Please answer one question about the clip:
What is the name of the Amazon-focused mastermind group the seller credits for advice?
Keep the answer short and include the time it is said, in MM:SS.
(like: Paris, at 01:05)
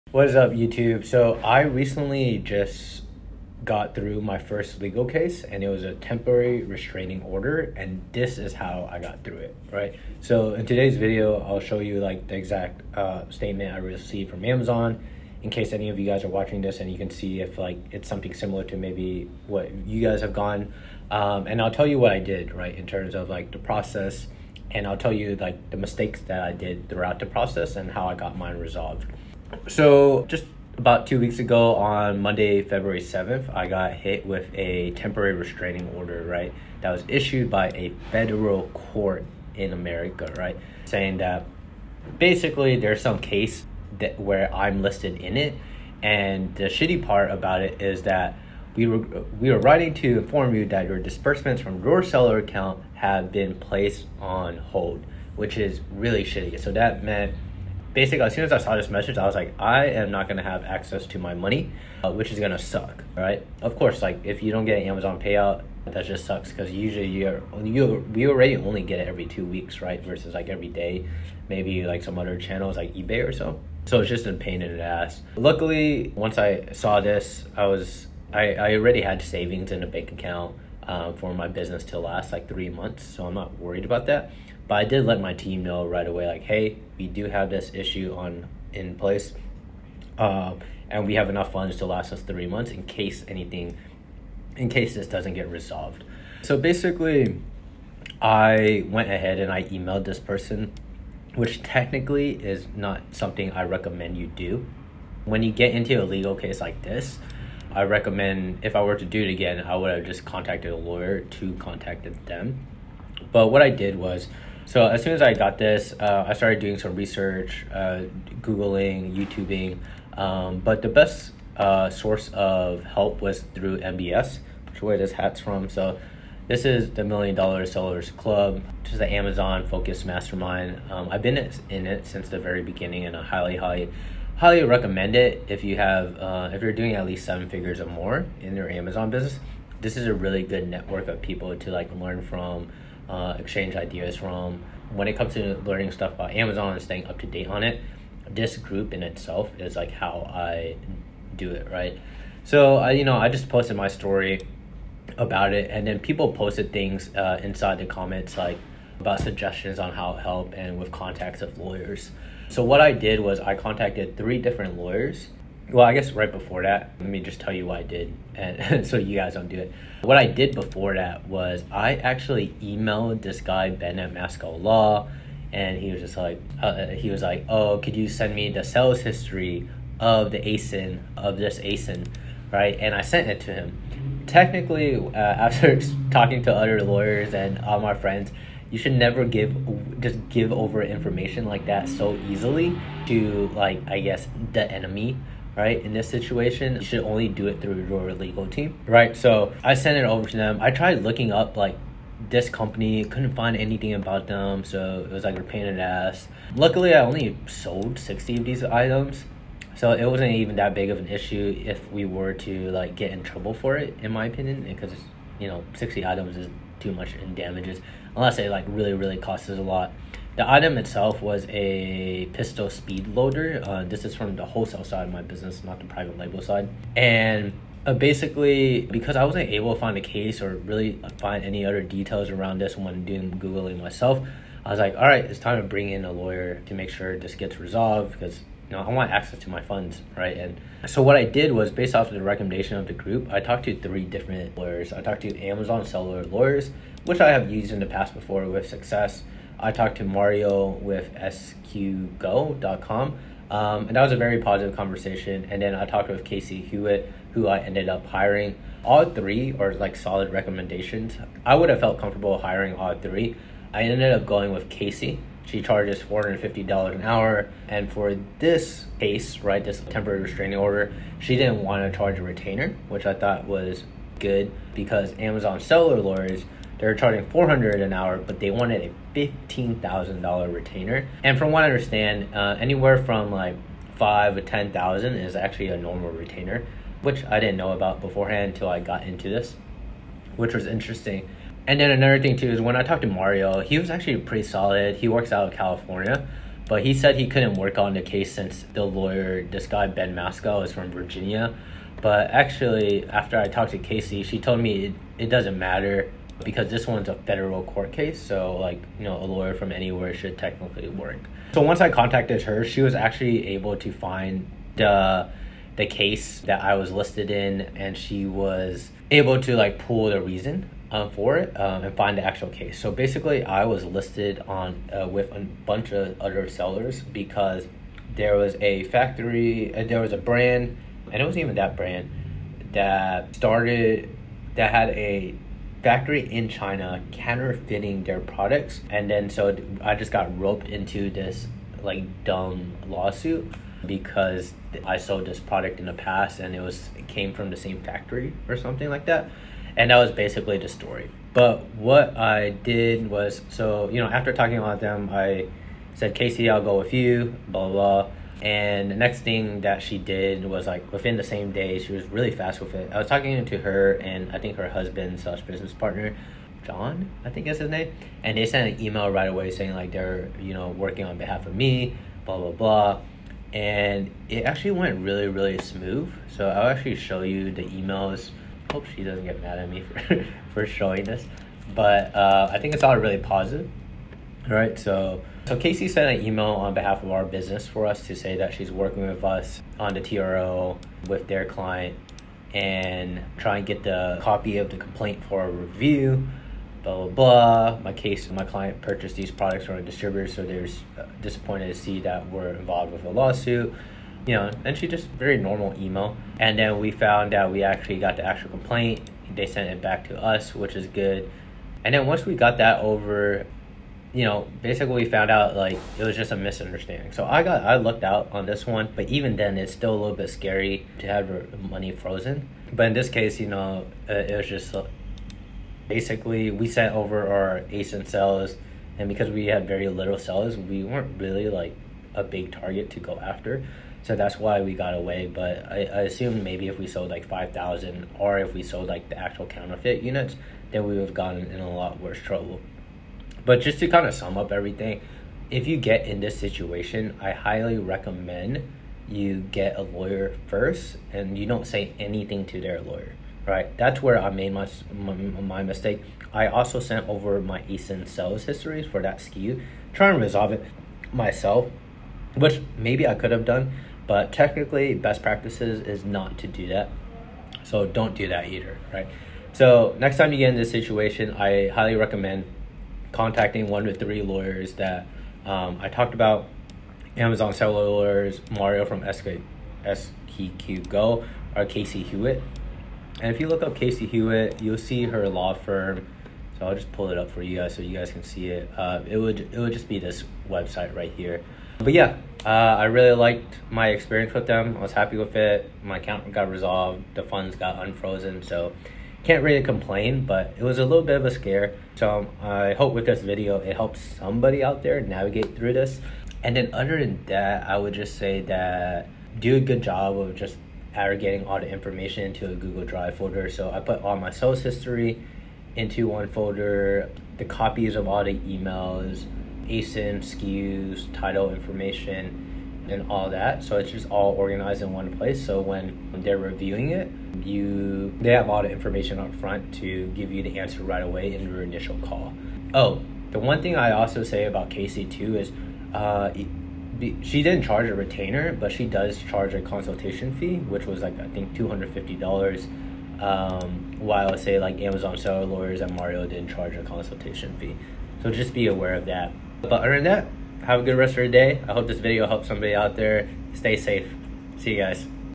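Million Dollar Sellers Club, at 02:07.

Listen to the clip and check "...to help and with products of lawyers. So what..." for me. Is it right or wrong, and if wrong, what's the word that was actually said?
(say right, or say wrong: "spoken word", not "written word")
wrong: "contacts", not "products".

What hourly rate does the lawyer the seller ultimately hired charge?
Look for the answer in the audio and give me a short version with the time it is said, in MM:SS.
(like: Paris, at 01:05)
$450, at 04:25.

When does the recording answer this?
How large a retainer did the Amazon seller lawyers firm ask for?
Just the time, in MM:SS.
04:39.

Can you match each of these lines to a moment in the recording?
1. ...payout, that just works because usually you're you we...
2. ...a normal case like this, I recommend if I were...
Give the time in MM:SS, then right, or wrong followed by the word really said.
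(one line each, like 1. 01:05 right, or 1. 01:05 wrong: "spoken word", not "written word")
1. 01:05 wrong: "sucks", not "works"
2. 01:46 wrong: "legal", not "normal".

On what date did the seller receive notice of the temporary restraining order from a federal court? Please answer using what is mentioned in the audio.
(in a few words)
Monday, February 7th.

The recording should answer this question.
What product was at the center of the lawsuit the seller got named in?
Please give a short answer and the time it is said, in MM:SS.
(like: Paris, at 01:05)
pistol speed loader, at 03:42.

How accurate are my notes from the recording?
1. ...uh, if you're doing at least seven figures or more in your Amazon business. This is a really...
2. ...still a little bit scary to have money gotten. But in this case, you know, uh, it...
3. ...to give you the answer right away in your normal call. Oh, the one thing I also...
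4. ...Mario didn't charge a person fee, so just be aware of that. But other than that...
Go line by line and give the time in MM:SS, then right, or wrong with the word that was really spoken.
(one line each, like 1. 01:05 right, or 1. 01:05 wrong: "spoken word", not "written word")
1. 02:16 right
2. 06:59 wrong: "frozen", not "gotten"
3. 08:49 wrong: "initial", not "normal"
4. 09:05 wrong: "consultation", not "person".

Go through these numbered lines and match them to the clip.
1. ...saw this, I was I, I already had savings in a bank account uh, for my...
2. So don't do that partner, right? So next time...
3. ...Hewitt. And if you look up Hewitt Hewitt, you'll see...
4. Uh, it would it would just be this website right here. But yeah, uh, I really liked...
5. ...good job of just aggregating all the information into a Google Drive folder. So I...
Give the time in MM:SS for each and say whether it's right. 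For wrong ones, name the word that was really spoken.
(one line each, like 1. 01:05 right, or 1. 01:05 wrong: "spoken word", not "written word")
1. 01:16 right
2. 07:47 wrong: "either", not "partner"
3. 08:02 wrong: "Casey", not "Hewitt"
4. 08:08 right
5. 08:29 right.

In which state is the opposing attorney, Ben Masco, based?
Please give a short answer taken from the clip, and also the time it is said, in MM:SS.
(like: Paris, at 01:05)
Virginia, at 05:00.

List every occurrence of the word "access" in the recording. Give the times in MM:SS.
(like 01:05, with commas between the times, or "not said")
01:00, 03:59.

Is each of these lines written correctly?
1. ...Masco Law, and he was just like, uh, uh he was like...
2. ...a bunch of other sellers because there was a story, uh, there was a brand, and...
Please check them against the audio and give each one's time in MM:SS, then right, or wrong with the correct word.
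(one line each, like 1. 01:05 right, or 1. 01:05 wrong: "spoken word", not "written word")
1. 02:54 right
2. 05:25 wrong: "factory", not "story".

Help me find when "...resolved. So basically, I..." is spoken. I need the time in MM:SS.
01:35.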